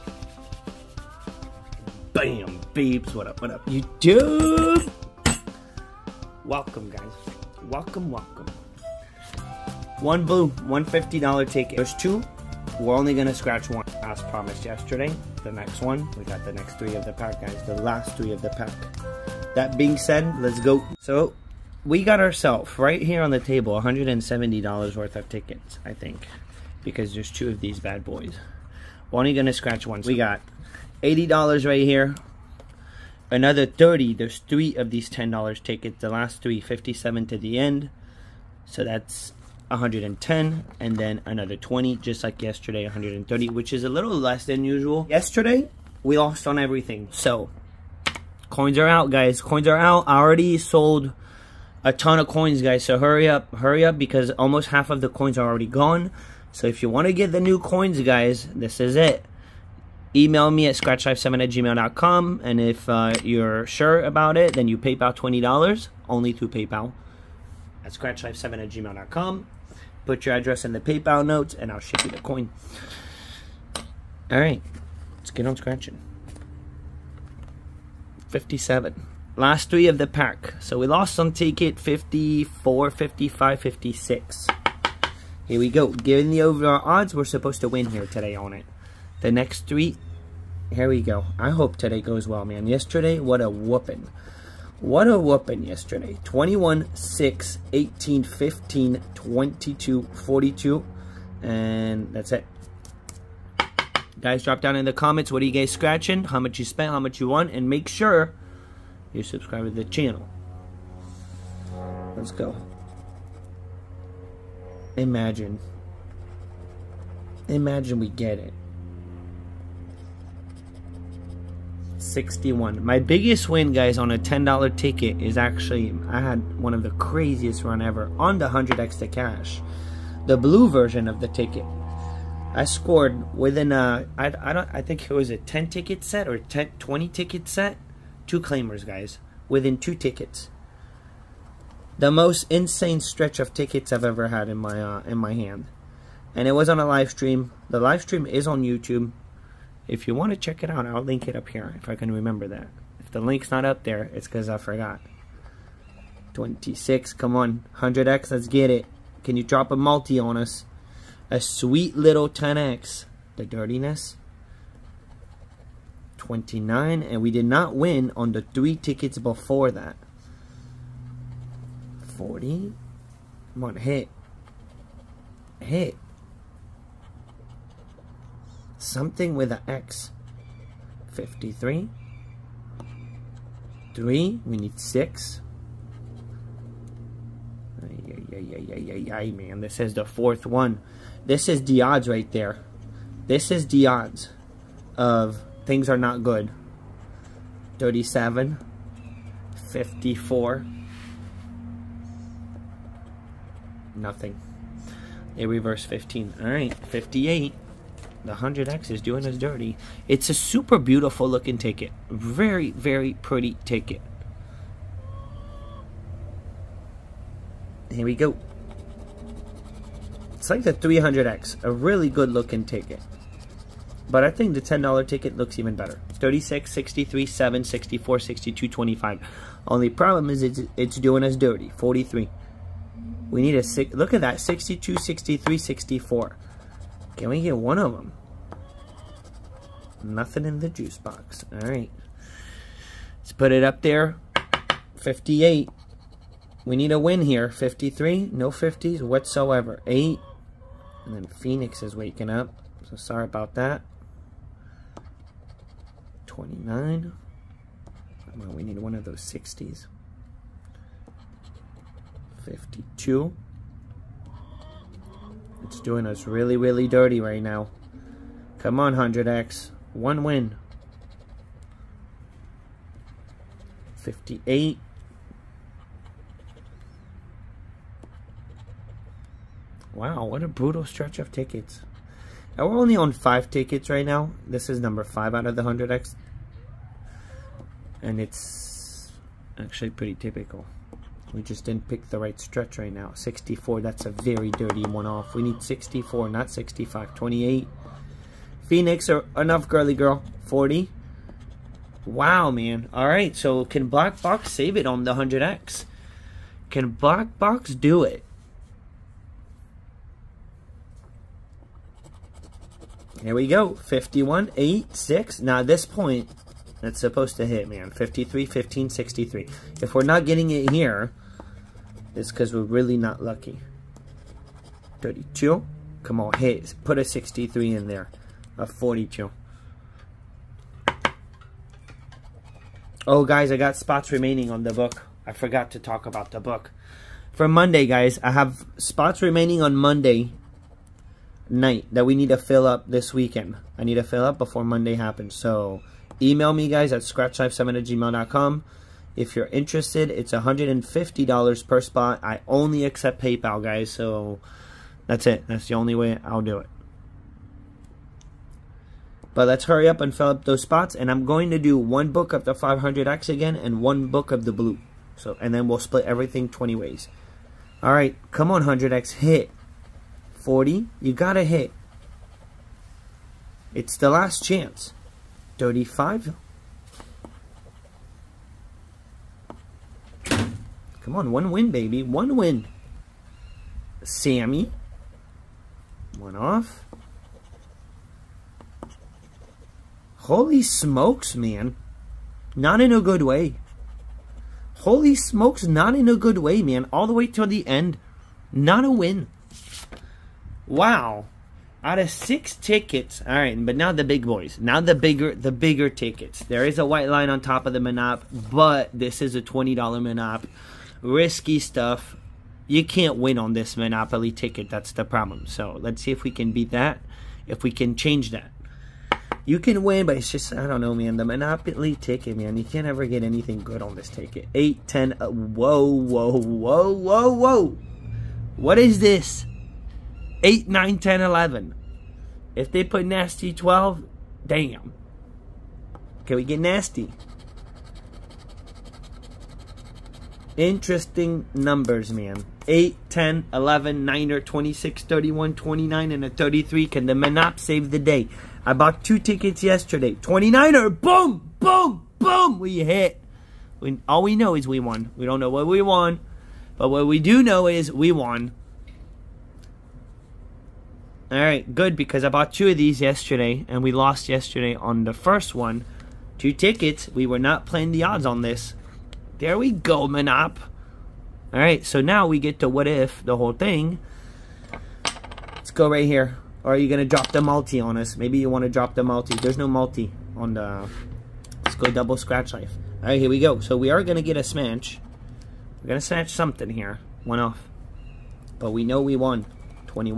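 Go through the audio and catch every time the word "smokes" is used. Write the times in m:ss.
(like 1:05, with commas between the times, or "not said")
6:30, 6:35.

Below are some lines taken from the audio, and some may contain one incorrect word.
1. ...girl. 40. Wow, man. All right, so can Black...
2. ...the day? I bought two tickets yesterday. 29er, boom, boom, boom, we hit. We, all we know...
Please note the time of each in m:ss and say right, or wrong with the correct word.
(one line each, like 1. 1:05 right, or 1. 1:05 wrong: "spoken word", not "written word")
1. 4:59 right
2. 7:27 right.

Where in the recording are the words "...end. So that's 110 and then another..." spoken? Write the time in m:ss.
0:37.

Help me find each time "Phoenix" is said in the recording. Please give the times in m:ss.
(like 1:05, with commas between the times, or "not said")
4:11, 4:58.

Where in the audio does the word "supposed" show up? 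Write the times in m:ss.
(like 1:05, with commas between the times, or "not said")
1:27, 5:16.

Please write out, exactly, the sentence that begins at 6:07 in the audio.
All right, come on, 100X, hit.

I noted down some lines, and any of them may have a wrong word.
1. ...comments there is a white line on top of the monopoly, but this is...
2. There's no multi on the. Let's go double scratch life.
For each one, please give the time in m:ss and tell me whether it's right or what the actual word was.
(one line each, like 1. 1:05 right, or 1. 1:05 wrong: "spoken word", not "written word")
1. 6:45 wrong: "tickets", not "comments"
2. 7:59 right.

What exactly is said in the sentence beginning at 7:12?
If they put nasty 12, damn.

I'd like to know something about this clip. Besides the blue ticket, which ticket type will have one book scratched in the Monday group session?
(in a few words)
500X.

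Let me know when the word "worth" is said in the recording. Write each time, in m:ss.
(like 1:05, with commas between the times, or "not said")
0:24.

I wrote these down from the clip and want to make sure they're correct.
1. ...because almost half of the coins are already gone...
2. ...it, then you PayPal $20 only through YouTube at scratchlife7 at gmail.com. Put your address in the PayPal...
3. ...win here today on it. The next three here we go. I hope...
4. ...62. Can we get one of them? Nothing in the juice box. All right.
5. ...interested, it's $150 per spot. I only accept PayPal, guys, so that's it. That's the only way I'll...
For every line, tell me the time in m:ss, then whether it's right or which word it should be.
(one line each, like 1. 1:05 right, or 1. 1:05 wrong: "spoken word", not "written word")
1. 0:53 right
2. 1:04 wrong: "PayPal", not "YouTube"
3. 1:27 right
4. 3:55 wrong: "64", not "62"
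5. 5:49 right.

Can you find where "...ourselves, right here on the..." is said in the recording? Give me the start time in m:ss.
0:22.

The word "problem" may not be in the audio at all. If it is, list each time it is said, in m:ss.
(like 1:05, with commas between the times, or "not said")
3:49, 6:55.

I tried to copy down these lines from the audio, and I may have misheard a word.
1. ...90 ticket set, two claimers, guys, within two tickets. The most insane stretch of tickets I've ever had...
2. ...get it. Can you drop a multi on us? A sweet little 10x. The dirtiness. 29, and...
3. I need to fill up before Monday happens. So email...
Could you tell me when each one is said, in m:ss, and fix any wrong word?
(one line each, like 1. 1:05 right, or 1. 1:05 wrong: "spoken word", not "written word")
1. 2:16 wrong: "20", not "90"
2. 2:38 right
3. 5:43 right.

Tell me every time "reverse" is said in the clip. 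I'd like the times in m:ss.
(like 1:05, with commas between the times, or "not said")
3:25.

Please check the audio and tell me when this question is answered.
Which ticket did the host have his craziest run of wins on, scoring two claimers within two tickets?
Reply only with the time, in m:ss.
2:08.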